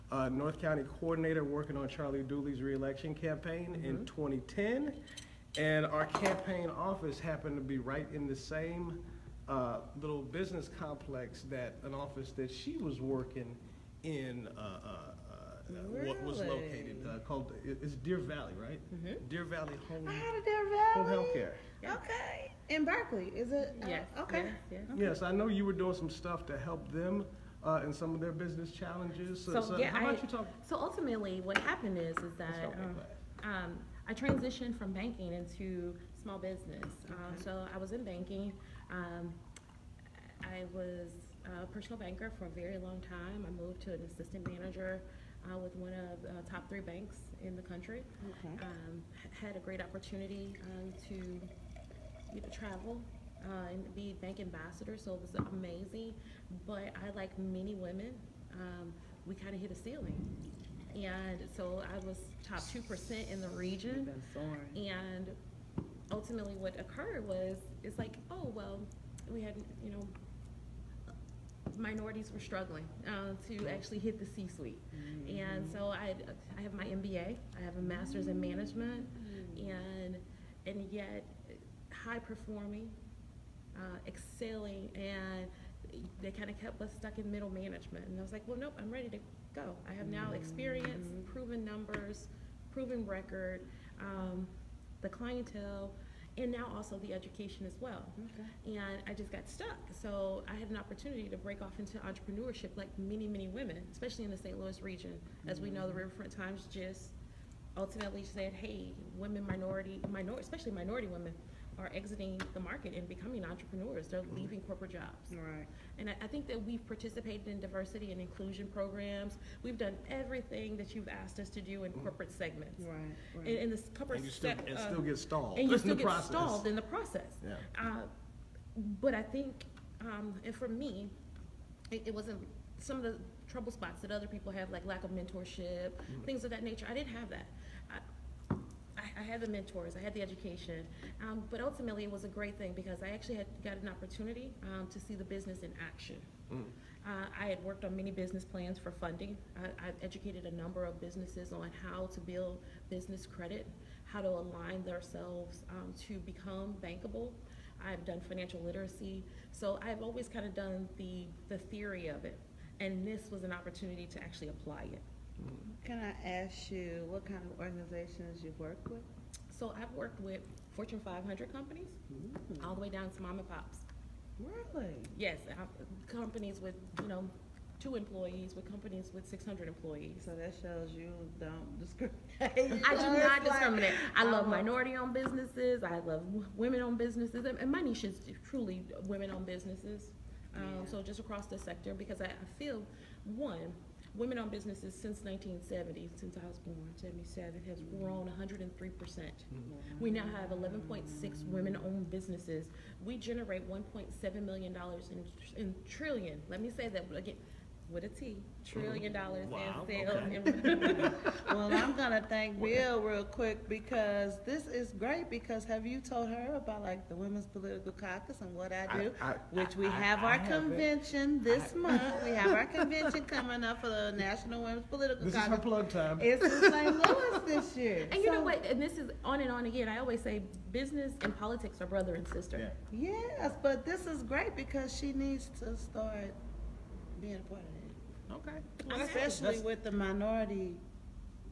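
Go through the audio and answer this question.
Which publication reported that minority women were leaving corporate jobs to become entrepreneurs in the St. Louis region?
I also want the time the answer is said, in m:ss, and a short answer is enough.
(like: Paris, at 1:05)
Riverfront Times, at 1:45.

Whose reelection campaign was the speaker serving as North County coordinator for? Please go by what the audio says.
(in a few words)
Charlie Dooley.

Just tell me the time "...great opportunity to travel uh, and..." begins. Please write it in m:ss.
0:49.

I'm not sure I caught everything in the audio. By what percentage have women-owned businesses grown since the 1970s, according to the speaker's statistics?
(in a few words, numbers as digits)
103%.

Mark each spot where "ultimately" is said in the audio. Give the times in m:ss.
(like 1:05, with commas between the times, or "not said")
0:30, 1:06, 1:47, 2:21.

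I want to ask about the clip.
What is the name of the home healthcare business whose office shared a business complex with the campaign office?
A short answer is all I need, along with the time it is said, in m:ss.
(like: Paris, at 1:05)
Deer Valley Home Healthcare, at 0:20.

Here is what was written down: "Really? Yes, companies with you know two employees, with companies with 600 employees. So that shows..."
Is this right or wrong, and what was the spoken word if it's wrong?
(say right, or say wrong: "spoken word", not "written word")
right.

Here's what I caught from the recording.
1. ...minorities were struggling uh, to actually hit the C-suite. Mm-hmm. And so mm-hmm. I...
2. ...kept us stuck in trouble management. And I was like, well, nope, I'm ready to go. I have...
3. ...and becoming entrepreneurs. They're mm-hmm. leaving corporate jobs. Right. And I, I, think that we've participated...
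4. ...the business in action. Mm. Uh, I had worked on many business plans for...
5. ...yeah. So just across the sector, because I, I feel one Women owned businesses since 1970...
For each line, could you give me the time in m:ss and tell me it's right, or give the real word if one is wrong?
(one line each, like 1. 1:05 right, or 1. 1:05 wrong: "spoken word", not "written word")
1. 1:11 right
2. 1:26 wrong: "middle", not "trouble"
3. 1:52 right
4. 2:25 right
5. 3:10 right.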